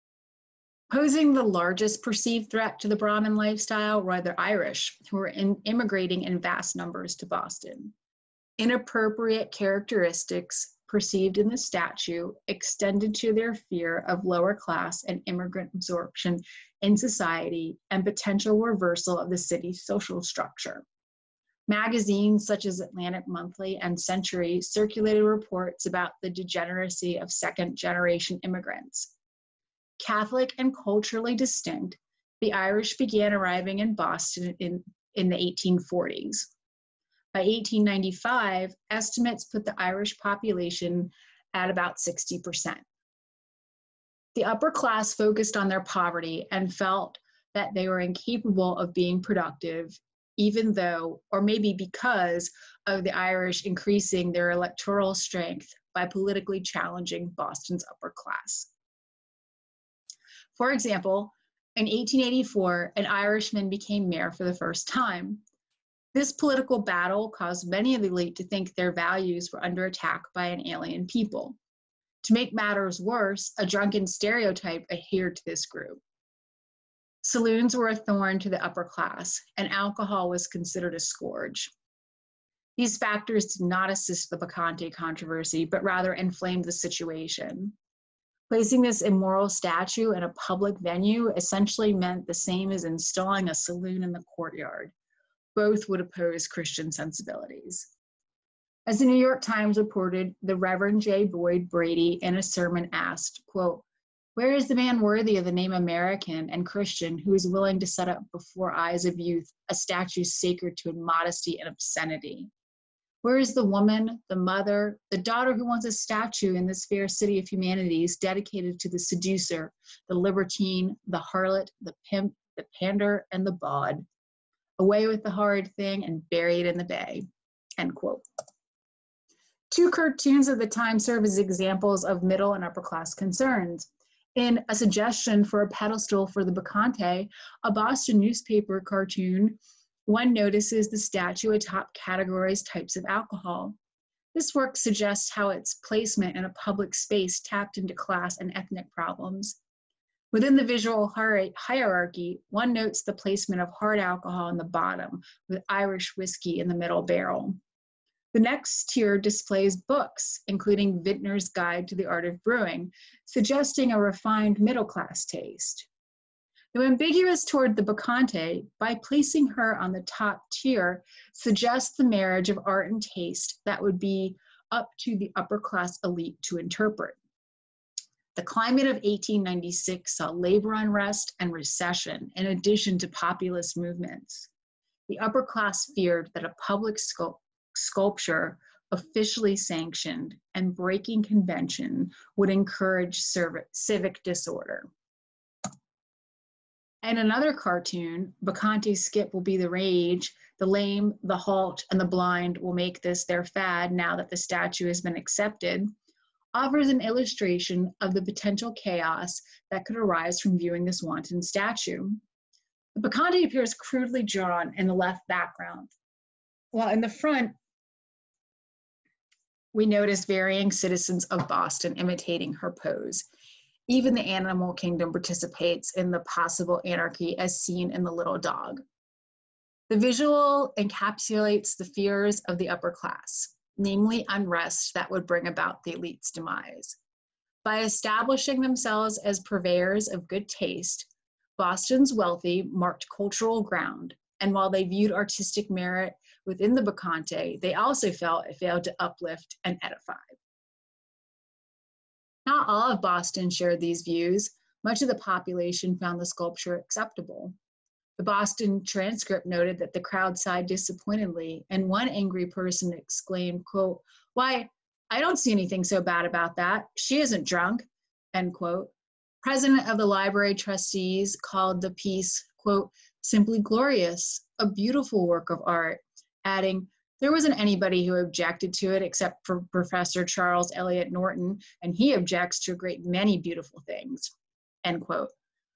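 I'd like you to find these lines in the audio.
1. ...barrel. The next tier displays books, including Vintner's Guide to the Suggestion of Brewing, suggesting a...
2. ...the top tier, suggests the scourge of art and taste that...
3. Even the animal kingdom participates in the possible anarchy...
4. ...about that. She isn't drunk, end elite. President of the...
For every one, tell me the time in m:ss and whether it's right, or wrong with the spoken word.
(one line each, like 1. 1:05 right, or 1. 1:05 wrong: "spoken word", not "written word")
1. 2:37 wrong: "Art", not "Suggestion"
2. 2:49 wrong: "marriage", not "scourge"
3. 3:43 right
4. 4:26 wrong: "quote", not "elite".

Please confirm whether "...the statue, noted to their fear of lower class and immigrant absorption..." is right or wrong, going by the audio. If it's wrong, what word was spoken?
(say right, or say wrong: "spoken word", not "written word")
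wrong: "extended", not "noted".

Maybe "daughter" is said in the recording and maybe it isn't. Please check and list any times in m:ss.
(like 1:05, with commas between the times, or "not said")
1:55.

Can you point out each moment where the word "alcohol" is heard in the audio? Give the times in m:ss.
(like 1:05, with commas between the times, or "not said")
1:19, 2:23, 2:33.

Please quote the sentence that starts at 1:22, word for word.
These factors did not assist the Bacchante controversy, but rather inflamed the situation.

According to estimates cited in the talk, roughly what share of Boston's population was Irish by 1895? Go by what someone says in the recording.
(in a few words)
60%.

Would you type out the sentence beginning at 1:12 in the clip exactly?
To make matters worse, a drunken stereotype adhered to this group.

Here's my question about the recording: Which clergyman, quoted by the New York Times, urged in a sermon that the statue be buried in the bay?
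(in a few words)
J. Boyd Brady.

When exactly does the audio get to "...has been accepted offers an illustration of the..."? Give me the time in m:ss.
3:24.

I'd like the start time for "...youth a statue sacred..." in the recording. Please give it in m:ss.
1:49.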